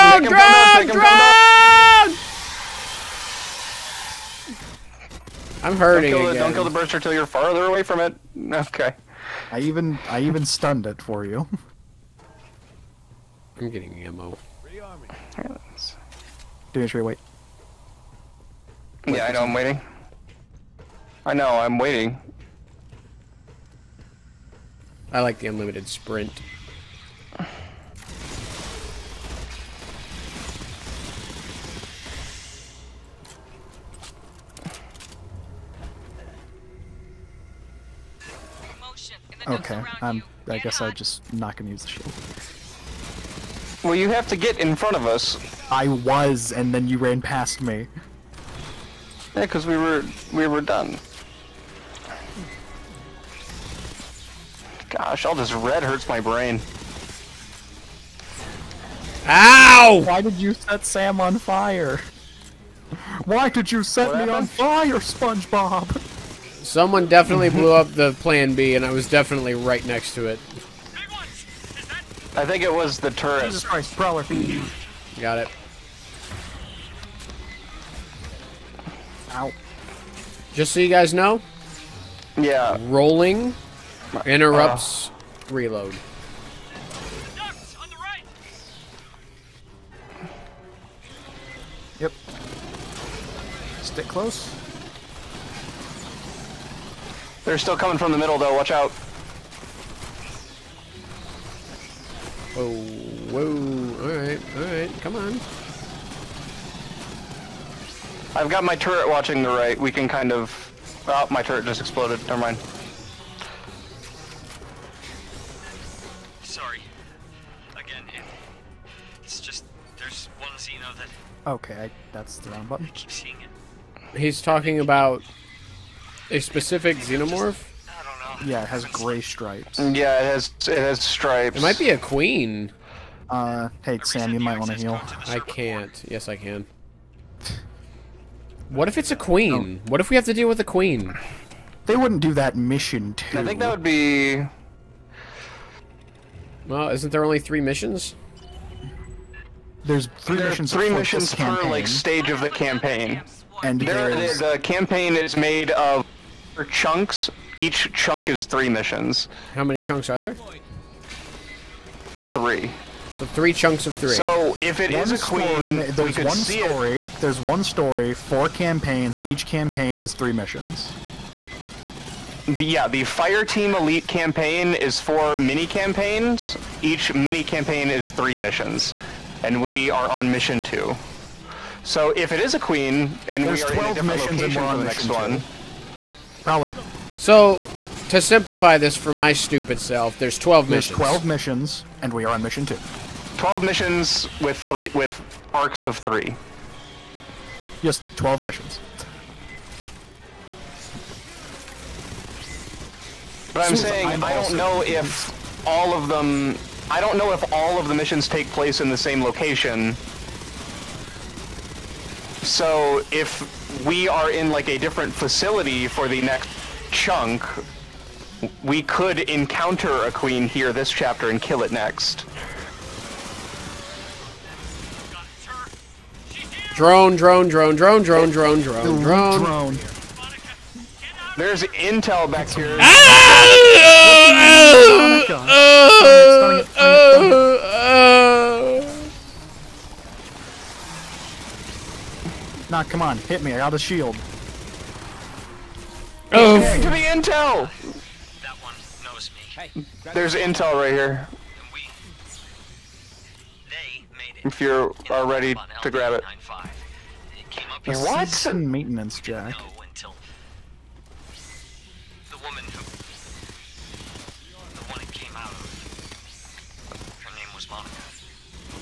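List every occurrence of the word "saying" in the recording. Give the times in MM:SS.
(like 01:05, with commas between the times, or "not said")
03:23.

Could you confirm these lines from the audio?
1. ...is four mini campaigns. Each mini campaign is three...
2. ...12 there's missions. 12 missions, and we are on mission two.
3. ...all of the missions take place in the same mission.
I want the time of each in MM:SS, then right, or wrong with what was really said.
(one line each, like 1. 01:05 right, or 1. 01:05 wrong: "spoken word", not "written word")
1. 02:54 right
2. 03:10 right
3. 03:27 wrong: "location", not "mission".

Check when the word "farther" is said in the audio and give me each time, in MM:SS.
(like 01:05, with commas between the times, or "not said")
00:07.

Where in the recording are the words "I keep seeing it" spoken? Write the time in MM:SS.
02:02.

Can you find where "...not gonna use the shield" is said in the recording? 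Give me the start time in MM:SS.
00:41.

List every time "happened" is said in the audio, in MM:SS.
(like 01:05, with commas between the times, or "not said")
01:04.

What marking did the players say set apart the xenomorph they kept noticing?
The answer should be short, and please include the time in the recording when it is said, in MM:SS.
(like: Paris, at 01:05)
Gray stripes, at 02:08.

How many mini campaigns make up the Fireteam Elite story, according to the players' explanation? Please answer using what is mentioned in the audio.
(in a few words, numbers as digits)
4.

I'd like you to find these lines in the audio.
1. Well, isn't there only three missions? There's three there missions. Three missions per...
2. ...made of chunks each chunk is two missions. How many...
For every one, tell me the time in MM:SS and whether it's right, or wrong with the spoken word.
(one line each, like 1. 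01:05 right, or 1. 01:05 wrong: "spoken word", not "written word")
1. 02:26 right
2. 02:35 wrong: "three", not "two".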